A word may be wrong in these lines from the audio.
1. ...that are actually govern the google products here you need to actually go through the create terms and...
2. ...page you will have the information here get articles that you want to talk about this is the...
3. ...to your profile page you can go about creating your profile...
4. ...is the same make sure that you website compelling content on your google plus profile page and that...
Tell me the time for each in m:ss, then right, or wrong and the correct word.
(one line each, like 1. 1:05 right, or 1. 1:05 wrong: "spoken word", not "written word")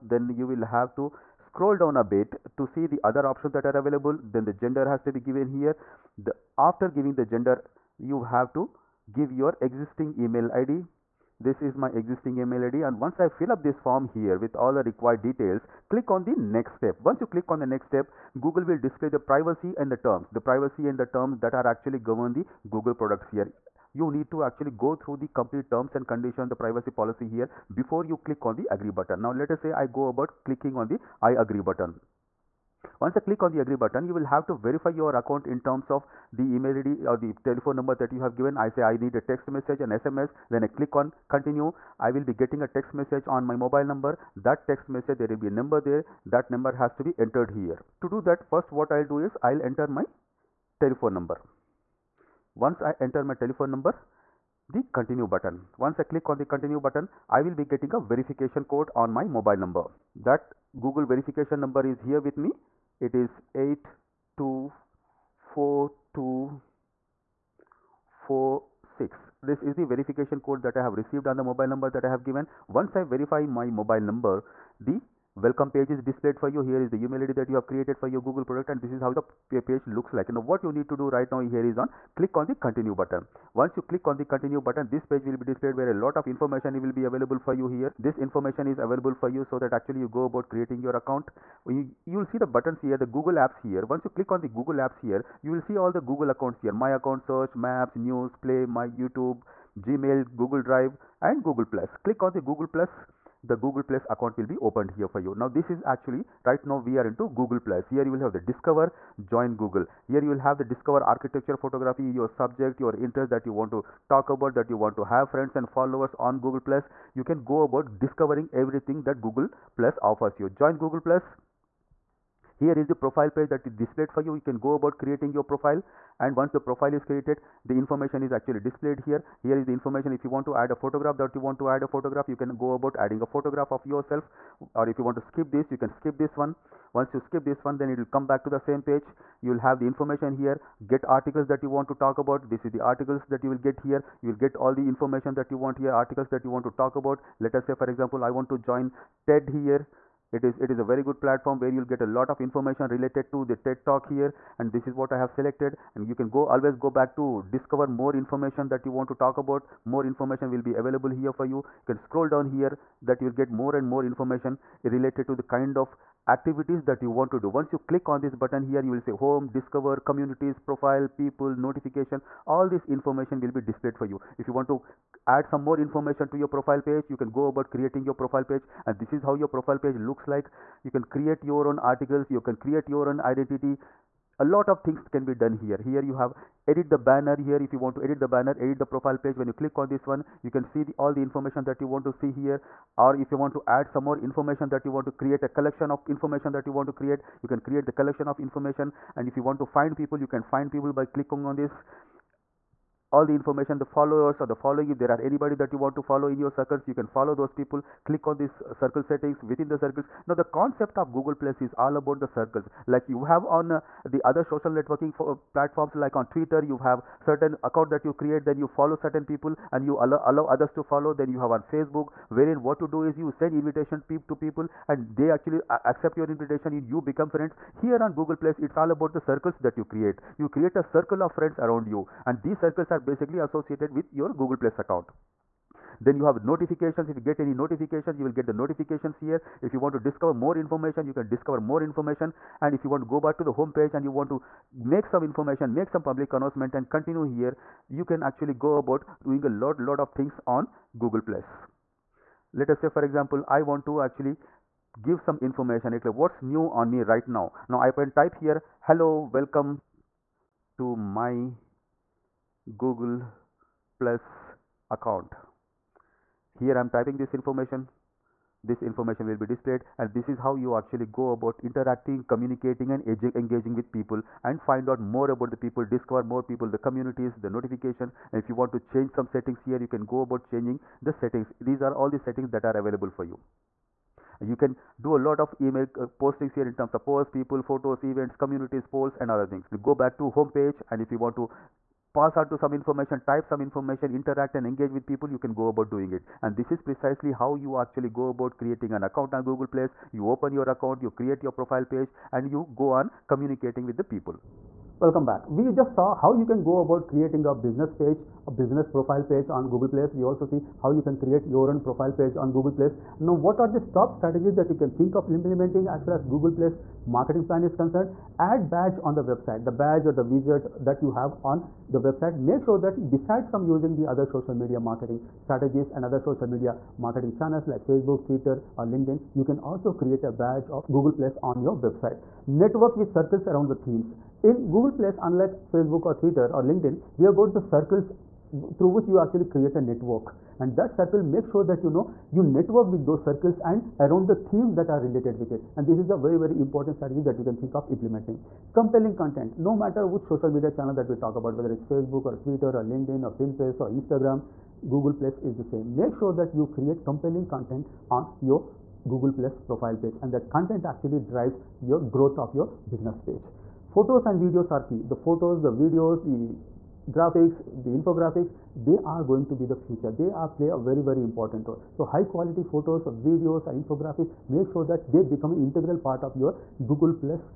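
1. 0:21 wrong: "complete", not "create"
2. 2:18 right
3. 2:56 right
4. 5:55 wrong: "create", not "website".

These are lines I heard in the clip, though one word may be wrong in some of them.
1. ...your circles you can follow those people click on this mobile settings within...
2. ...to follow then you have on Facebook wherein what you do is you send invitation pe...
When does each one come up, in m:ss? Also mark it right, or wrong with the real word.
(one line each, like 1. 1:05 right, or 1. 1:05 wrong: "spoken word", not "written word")
1. 3:26 wrong: "circle", not "mobile"
2. 3:40 right.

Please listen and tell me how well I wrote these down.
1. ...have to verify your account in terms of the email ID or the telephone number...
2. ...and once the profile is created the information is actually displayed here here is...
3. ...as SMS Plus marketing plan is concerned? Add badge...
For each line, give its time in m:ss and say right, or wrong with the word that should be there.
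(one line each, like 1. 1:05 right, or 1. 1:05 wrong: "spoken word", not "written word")
1. 0:34 right
2. 2:06 right
3. 5:16 wrong: "Google", not "SMS".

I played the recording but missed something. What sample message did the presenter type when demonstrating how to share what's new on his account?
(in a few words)
Hello welcome to my Google plus account.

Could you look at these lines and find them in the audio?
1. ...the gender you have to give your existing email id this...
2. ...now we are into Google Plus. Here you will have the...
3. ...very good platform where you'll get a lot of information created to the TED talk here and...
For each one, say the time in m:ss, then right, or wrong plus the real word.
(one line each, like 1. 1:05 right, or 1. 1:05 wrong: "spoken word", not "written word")
1. 0:07 right
2. 1:46 right
3. 2:30 wrong: "related", not "created".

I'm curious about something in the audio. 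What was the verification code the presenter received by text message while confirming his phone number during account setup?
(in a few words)
824246.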